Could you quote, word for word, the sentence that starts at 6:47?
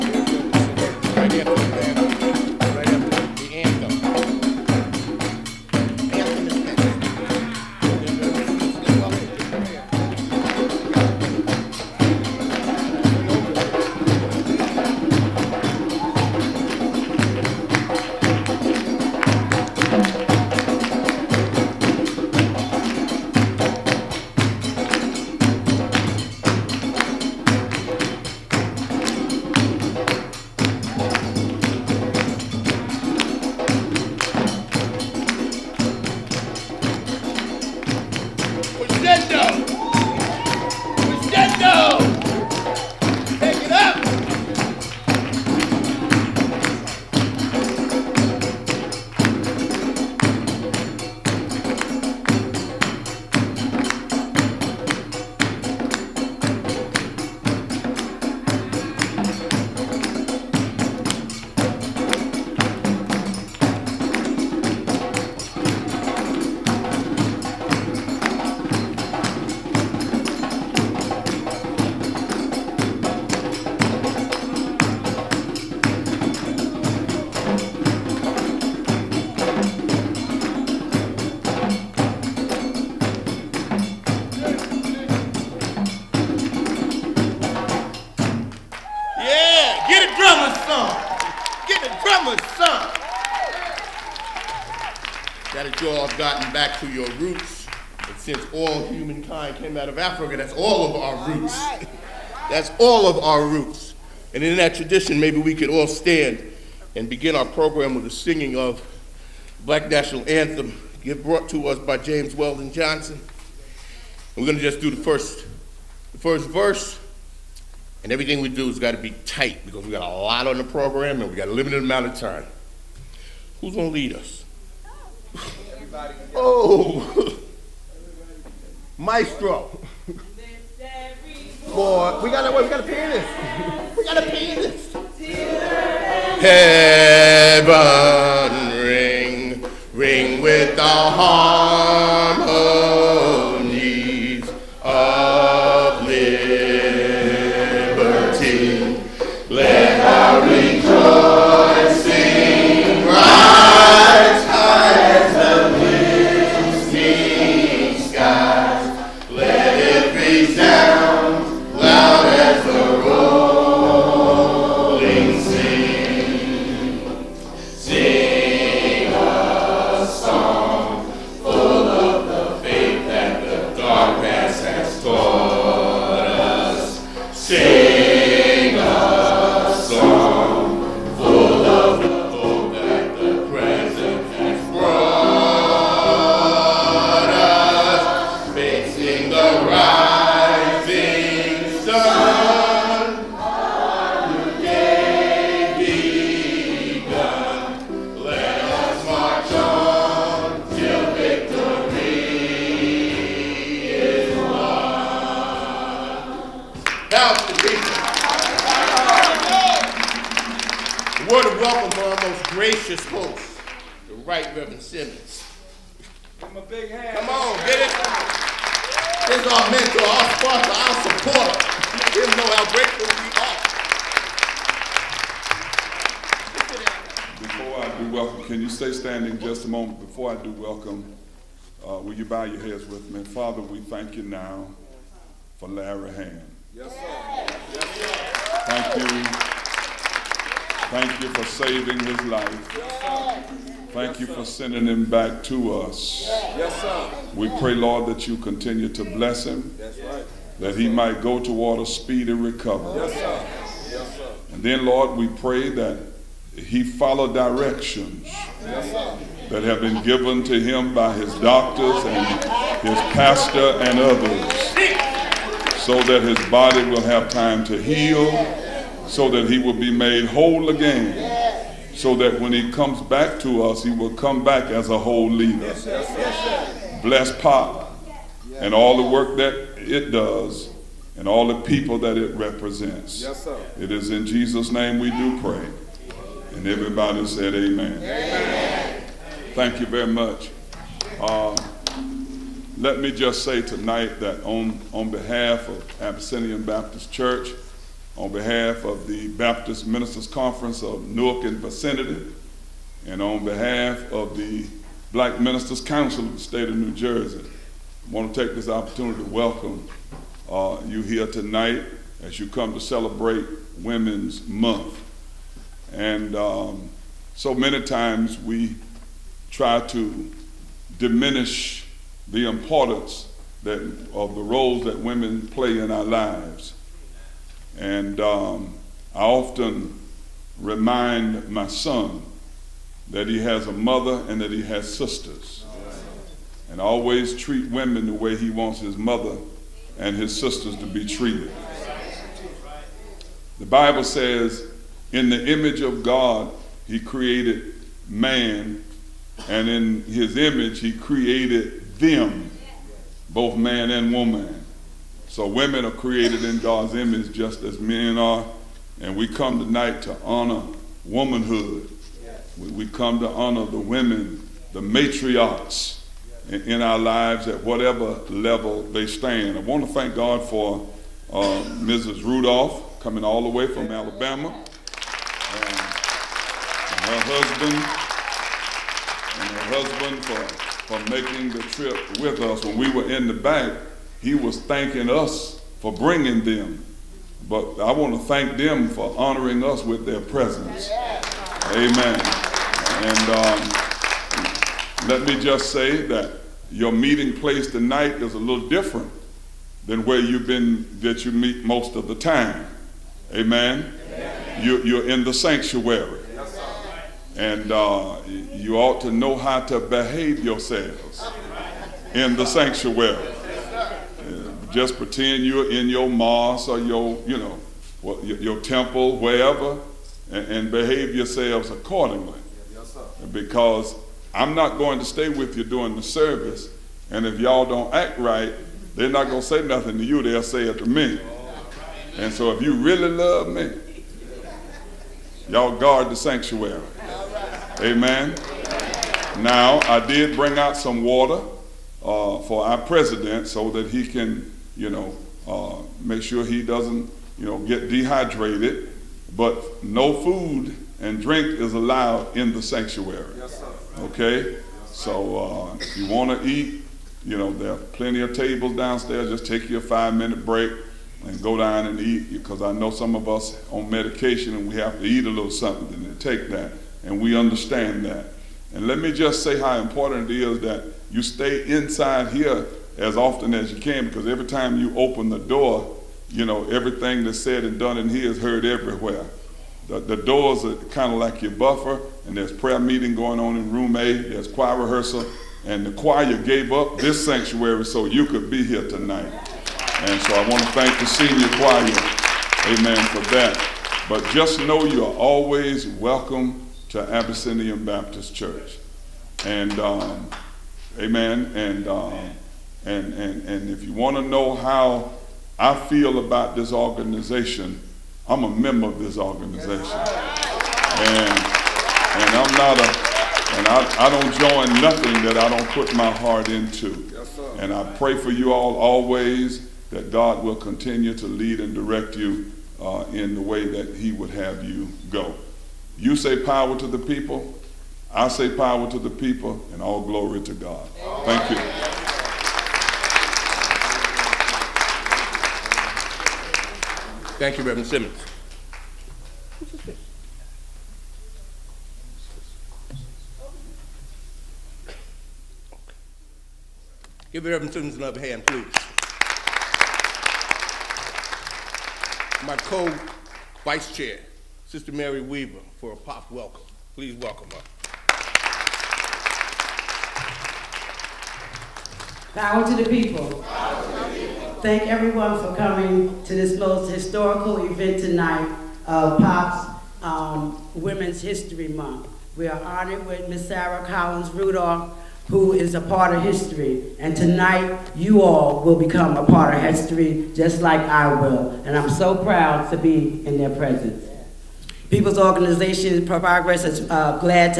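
And uh, you ought to know how to behave yourselves in the sanctuary.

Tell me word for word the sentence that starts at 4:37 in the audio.
Bless Pop and all the work that it does and all the people that it represents.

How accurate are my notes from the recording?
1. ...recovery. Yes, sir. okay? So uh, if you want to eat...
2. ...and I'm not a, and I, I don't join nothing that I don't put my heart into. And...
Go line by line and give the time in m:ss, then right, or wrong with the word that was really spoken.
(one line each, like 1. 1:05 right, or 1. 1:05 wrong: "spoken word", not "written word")
1. 7:32 wrong: "sanctuary", not "recovery"
2. 8:32 right.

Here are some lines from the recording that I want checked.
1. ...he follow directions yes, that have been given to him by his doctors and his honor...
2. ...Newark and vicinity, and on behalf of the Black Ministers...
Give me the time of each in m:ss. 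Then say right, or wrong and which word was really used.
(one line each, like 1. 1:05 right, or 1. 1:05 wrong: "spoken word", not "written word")
1. 4:16 wrong: "pastor", not "honor"
2. 5:01 right.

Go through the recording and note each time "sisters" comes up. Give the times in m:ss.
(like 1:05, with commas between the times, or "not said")
5:34, 5:40, 9:14.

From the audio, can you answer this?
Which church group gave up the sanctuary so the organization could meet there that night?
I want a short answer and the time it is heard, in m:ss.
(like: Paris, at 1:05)
The senior choir, at 8:11.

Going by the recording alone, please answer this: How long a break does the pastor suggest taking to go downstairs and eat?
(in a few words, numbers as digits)
5 minutes.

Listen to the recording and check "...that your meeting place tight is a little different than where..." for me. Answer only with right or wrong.
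wrong.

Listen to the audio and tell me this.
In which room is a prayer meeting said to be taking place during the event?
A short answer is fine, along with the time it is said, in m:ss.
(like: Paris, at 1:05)
Room A, at 8:03.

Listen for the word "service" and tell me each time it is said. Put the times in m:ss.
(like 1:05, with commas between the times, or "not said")
7:06.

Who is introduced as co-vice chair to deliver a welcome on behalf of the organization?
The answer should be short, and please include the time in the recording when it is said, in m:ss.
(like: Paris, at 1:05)
Mary Weaver, at 9:14.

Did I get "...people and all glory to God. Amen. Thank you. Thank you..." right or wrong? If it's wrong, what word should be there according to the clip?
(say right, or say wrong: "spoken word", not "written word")
right.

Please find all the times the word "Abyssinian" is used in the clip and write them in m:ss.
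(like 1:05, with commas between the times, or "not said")
4:56, 8:17.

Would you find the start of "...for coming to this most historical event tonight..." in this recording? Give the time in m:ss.
9:25.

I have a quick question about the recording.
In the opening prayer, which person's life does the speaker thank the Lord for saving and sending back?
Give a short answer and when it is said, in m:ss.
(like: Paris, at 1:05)
Larry Hamm, at 3:55.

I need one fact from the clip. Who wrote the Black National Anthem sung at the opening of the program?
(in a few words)
James Weldon Johnson.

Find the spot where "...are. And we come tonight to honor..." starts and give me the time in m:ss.
5:58.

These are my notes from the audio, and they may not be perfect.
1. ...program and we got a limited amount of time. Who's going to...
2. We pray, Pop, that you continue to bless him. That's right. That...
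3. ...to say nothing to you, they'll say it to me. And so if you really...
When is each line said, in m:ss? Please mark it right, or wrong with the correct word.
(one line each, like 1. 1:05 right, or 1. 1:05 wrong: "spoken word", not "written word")
1. 2:00 right
2. 4:07 wrong: "Lord", not "Pop"
3. 7:09 right.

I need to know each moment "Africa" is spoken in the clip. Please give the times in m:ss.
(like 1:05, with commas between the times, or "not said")
1:39.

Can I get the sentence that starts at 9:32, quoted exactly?
We are honored with Miss Sarah Collins Rudolph, who is a part of history.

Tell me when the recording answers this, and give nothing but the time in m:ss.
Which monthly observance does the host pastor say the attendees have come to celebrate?
5:13.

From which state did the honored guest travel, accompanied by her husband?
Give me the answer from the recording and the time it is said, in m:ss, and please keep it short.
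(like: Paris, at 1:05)
Alabama, at 6:13.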